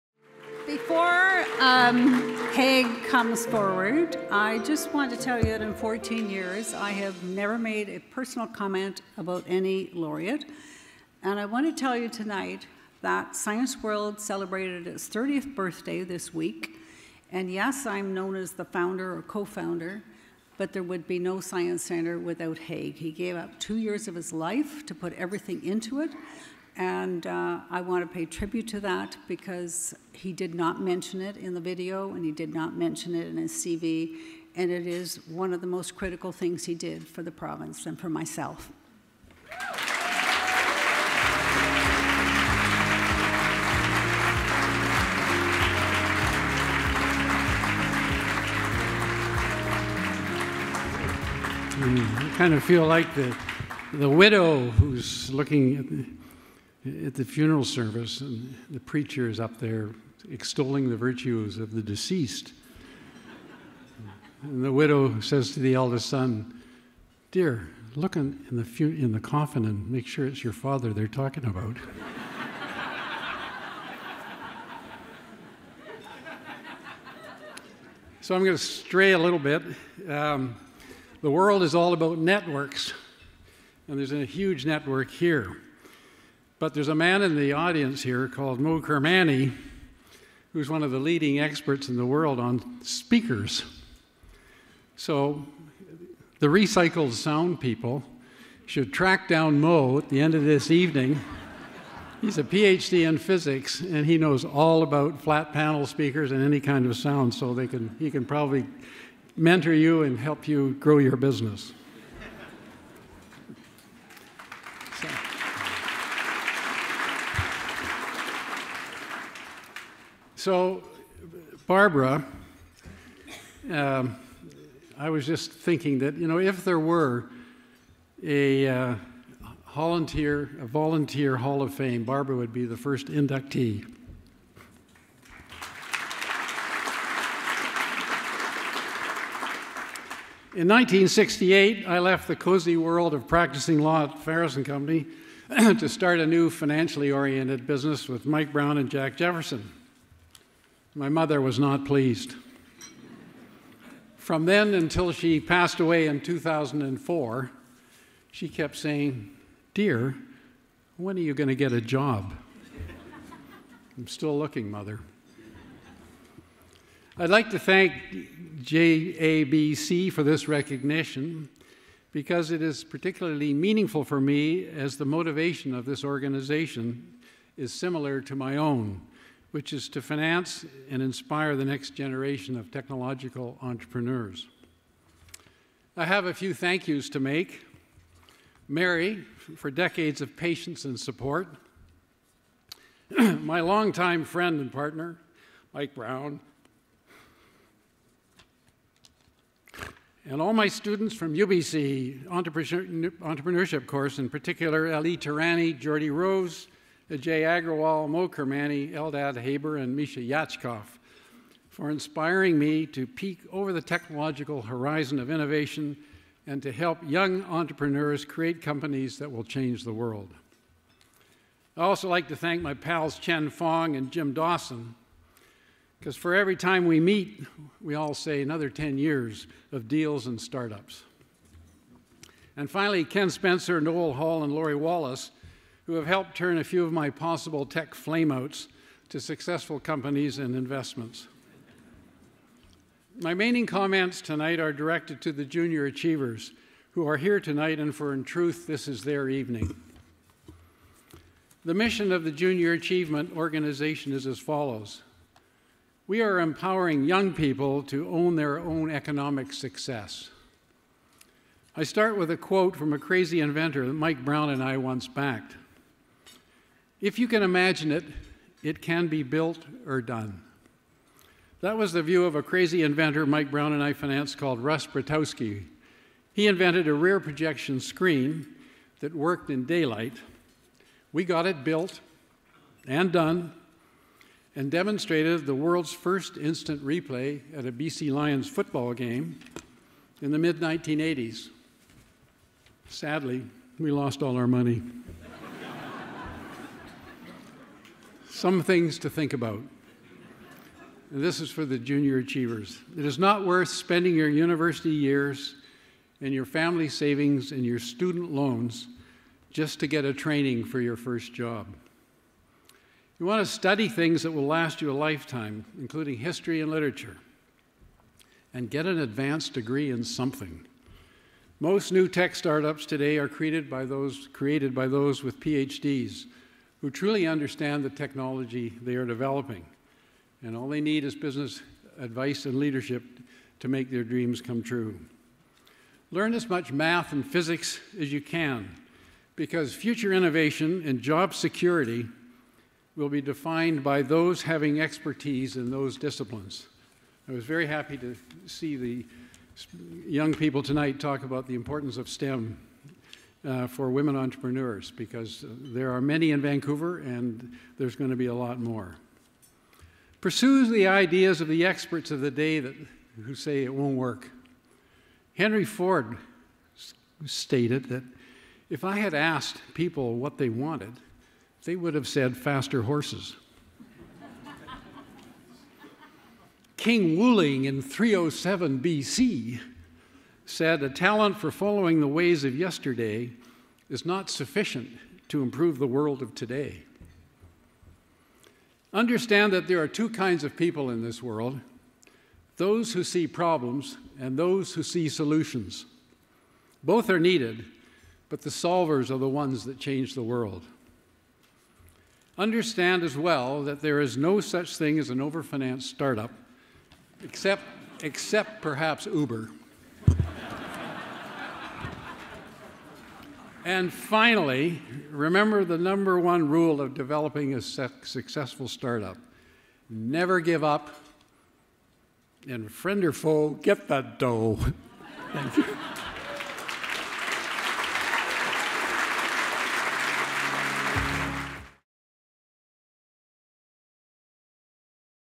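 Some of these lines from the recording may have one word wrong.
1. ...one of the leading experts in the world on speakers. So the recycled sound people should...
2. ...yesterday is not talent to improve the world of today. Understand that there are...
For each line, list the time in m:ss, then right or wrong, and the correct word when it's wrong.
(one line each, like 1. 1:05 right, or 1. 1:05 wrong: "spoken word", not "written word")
1. 1:30 right
2. 6:22 wrong: "sufficient", not "talent".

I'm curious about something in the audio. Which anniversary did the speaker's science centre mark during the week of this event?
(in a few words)
30th birthday.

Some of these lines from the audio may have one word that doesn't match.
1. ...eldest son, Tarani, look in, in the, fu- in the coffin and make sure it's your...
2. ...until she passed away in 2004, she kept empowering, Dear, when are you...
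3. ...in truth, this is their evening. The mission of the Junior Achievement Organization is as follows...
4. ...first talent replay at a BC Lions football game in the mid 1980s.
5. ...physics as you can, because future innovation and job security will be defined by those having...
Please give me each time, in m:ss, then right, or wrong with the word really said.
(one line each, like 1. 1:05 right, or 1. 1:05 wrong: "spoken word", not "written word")
1. 1:05 wrong: "Dear", not "Tarani"
2. 2:34 wrong: "saying", not "empowering"
3. 4:08 right
4. 4:45 wrong: "instant", not "talent"
5. 5:37 right.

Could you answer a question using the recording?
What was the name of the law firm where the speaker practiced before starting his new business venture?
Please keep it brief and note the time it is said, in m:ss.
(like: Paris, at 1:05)
Ferris and Company, at 2:24.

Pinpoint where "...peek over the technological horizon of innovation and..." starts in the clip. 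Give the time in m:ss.
3:33.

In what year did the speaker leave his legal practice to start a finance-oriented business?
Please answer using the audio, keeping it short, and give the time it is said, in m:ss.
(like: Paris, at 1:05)
1968, at 2:20.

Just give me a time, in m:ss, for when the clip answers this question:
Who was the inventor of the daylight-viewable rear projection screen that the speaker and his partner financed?
4:34.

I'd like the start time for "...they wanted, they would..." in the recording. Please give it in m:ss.
6:10.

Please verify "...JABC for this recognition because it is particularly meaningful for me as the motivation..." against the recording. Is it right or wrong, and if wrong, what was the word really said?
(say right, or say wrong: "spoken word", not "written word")
right.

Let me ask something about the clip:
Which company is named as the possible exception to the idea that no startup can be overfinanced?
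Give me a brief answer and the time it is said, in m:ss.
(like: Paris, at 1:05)
Uber, at 6:49.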